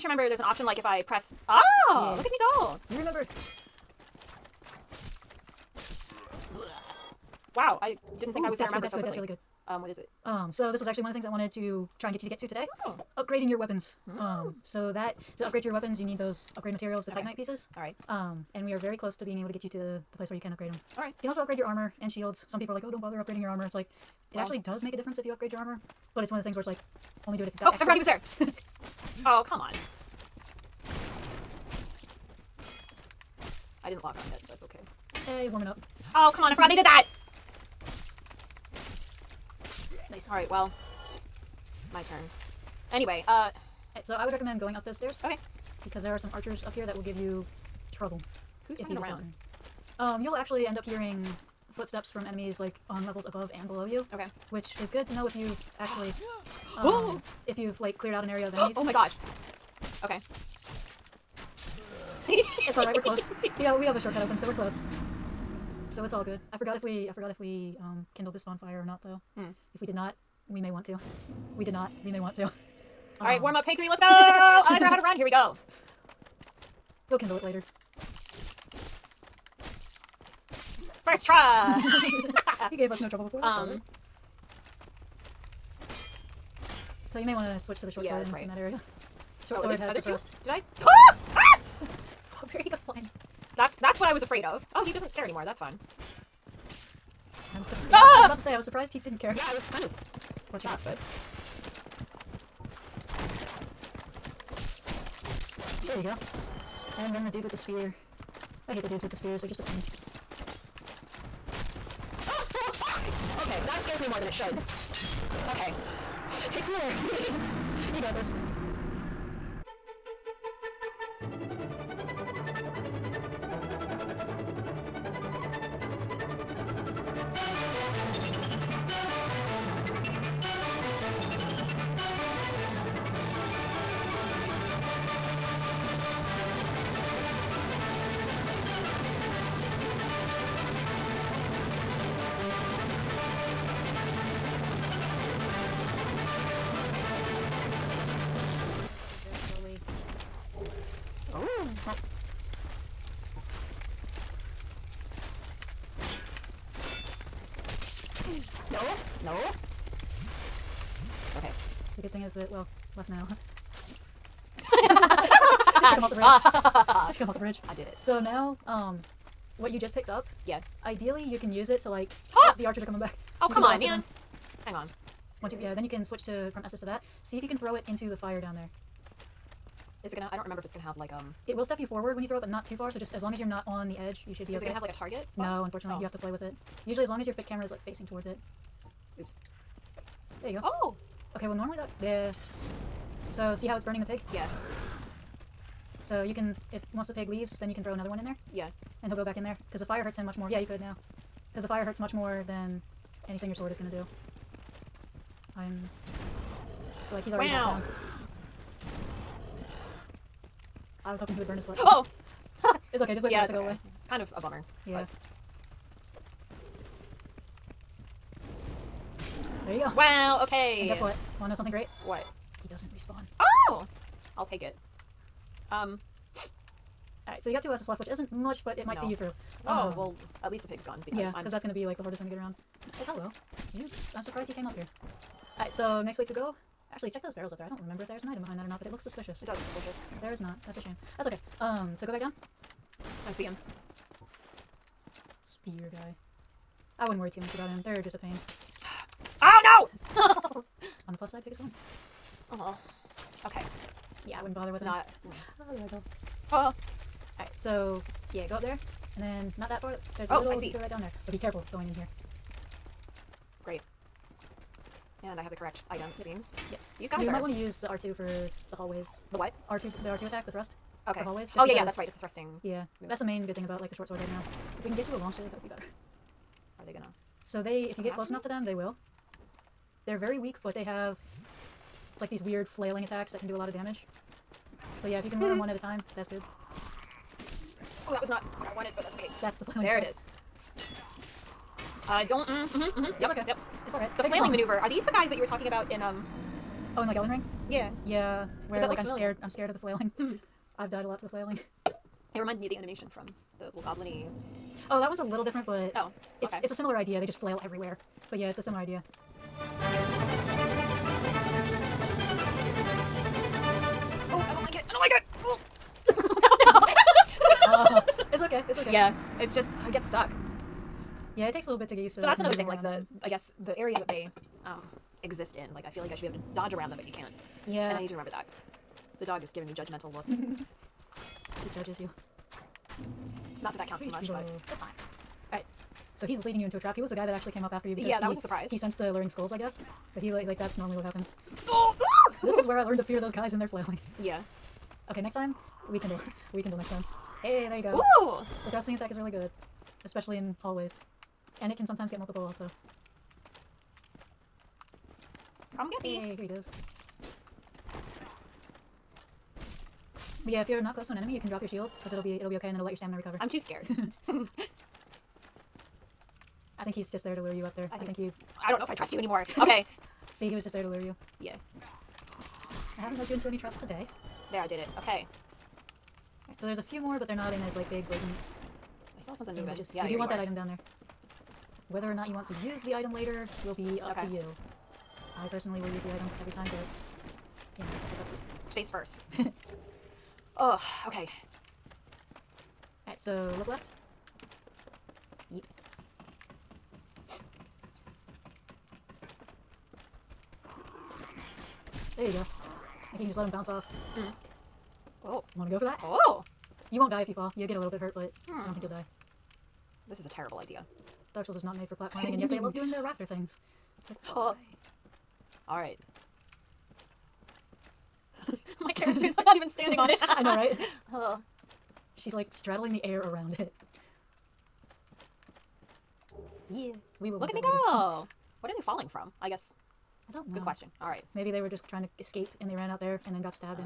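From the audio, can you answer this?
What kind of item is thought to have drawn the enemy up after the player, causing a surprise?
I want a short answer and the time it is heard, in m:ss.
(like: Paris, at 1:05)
luring skulls, at 5:39.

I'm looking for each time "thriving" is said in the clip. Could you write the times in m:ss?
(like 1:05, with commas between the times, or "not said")
not said.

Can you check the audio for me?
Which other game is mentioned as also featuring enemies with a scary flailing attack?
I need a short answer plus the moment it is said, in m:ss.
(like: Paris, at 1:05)
Elden Ring, at 4:57.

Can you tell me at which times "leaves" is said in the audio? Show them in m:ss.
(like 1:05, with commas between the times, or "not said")
3:17.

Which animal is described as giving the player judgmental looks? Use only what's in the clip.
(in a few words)
The dog.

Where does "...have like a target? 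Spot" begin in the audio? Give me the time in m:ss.
3:04.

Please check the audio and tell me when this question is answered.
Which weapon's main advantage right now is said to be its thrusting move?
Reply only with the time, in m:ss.
4:33.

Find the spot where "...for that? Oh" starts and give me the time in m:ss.
6:45.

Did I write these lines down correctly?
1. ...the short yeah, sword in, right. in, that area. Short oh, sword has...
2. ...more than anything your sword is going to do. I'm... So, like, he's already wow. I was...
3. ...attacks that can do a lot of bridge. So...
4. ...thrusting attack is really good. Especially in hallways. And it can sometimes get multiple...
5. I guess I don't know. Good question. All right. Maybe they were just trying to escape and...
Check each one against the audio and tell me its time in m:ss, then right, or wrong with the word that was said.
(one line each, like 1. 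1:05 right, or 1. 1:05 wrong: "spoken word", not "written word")
1. 1:27 right
2. 3:22 right
3. 4:43 wrong: "damage", not "bridge"
4. 5:48 right
5. 7:09 right.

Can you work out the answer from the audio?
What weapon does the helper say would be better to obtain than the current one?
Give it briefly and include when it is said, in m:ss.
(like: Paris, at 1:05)
long sword, at 4:35.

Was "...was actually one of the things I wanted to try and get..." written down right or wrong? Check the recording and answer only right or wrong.
right.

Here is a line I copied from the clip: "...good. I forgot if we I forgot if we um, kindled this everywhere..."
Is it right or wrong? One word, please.
wrong.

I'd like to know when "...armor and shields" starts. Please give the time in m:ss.
0:21.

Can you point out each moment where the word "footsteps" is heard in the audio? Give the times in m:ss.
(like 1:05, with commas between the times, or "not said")
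0:51.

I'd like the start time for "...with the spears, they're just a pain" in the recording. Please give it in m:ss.
1:49.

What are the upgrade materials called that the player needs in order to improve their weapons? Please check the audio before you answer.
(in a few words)
Titanite pieces.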